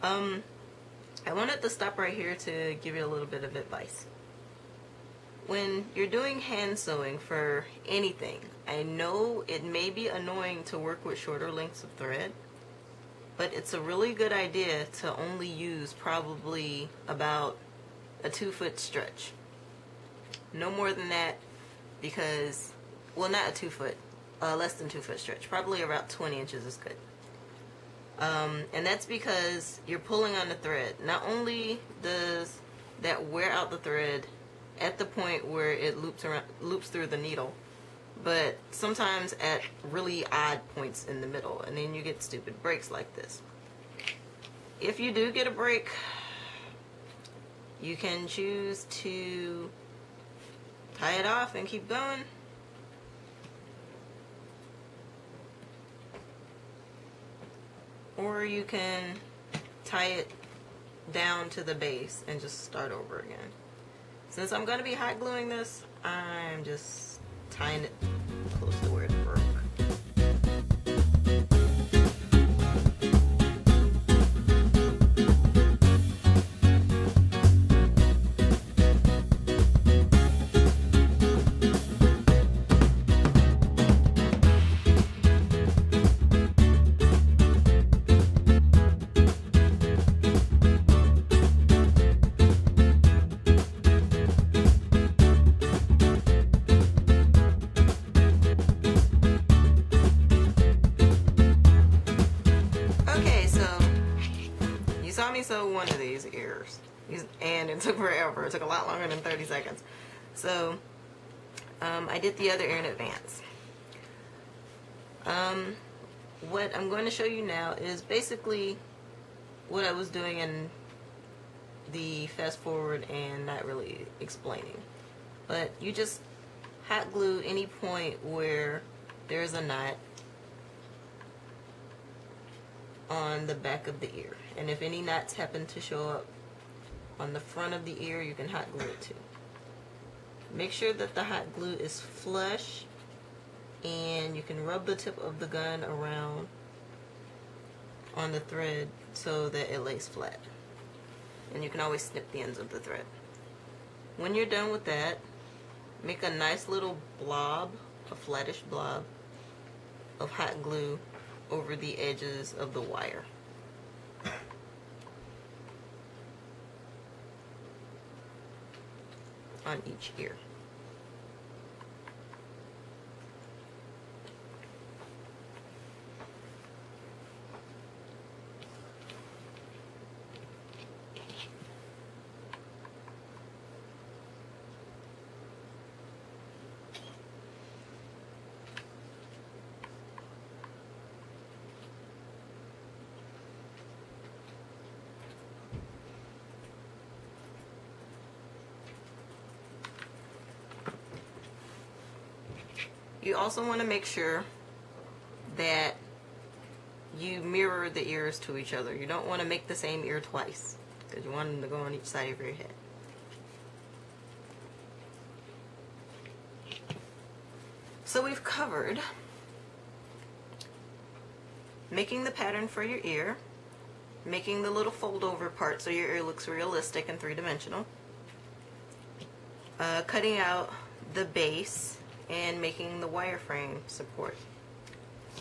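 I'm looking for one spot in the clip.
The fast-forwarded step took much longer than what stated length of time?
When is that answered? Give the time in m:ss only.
1:49.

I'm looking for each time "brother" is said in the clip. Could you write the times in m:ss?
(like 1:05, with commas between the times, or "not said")
not said.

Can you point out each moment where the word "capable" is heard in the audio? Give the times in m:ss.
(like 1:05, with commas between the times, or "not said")
not said.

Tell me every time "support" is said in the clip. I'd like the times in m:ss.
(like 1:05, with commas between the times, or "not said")
3:53.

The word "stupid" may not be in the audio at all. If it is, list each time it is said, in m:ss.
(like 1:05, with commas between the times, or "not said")
0:42.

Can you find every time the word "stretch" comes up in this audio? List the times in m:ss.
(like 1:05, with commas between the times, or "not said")
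0:18, 0:25.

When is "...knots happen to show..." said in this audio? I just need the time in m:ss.
2:14.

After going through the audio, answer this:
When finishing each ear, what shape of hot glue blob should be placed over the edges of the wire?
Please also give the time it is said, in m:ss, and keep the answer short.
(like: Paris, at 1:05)
flattish blob, at 2:38.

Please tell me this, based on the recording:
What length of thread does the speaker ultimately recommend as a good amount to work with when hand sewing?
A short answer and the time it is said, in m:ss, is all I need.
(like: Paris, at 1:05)
20 inches, at 0:25.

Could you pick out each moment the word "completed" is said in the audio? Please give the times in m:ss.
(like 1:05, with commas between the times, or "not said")
not said.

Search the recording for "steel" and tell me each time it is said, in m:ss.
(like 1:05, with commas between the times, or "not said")
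not said.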